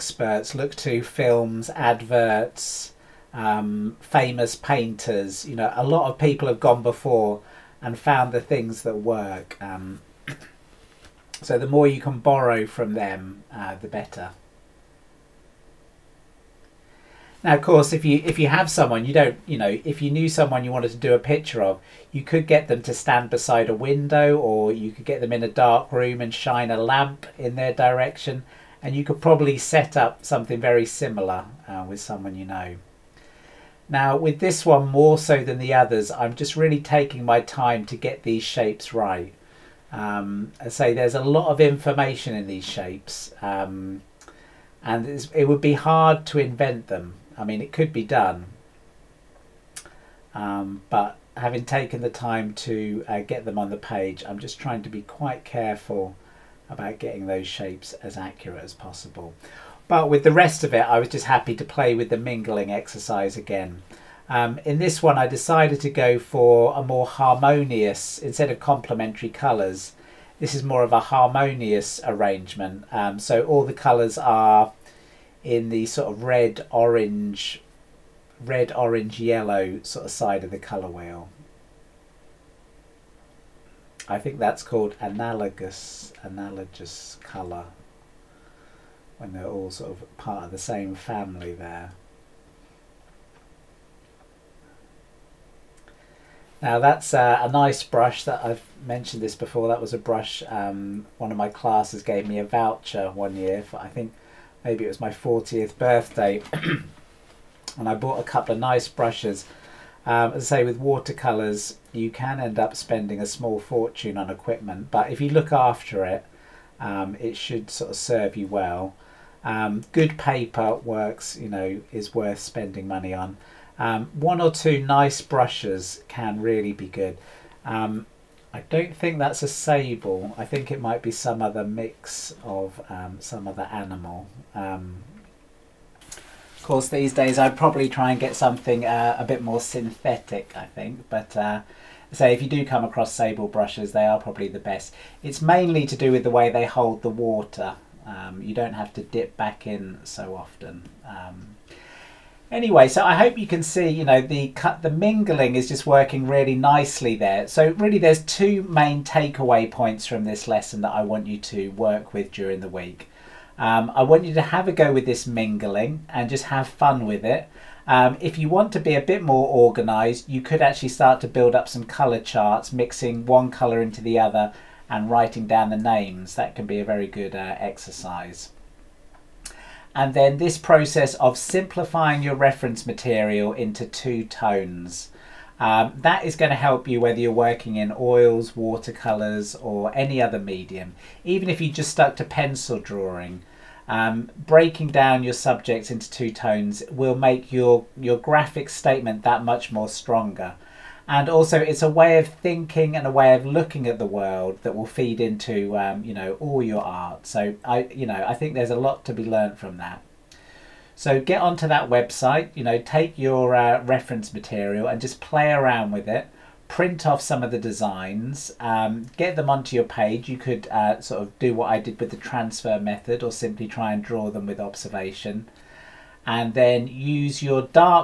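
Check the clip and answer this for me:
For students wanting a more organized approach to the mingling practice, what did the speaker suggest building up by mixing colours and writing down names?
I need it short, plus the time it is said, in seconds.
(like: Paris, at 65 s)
color charts, at 171 s.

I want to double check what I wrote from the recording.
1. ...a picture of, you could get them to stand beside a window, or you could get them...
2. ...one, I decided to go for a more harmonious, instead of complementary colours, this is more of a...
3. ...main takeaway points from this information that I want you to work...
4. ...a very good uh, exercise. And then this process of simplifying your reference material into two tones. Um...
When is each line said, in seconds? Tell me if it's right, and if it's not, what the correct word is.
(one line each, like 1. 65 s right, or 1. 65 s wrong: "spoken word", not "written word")
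1. 21 s right
2. 65 s right
3. 158 s wrong: "lesson", not "information"
4. 176 s right.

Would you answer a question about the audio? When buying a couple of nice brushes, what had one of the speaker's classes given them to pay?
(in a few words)
a voucher.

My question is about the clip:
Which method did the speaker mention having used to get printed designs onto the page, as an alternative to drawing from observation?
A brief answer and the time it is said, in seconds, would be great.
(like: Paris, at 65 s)
transfer method, at 222 s.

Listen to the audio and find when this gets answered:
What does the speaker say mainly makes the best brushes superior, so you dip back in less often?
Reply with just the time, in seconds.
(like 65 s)
146 s.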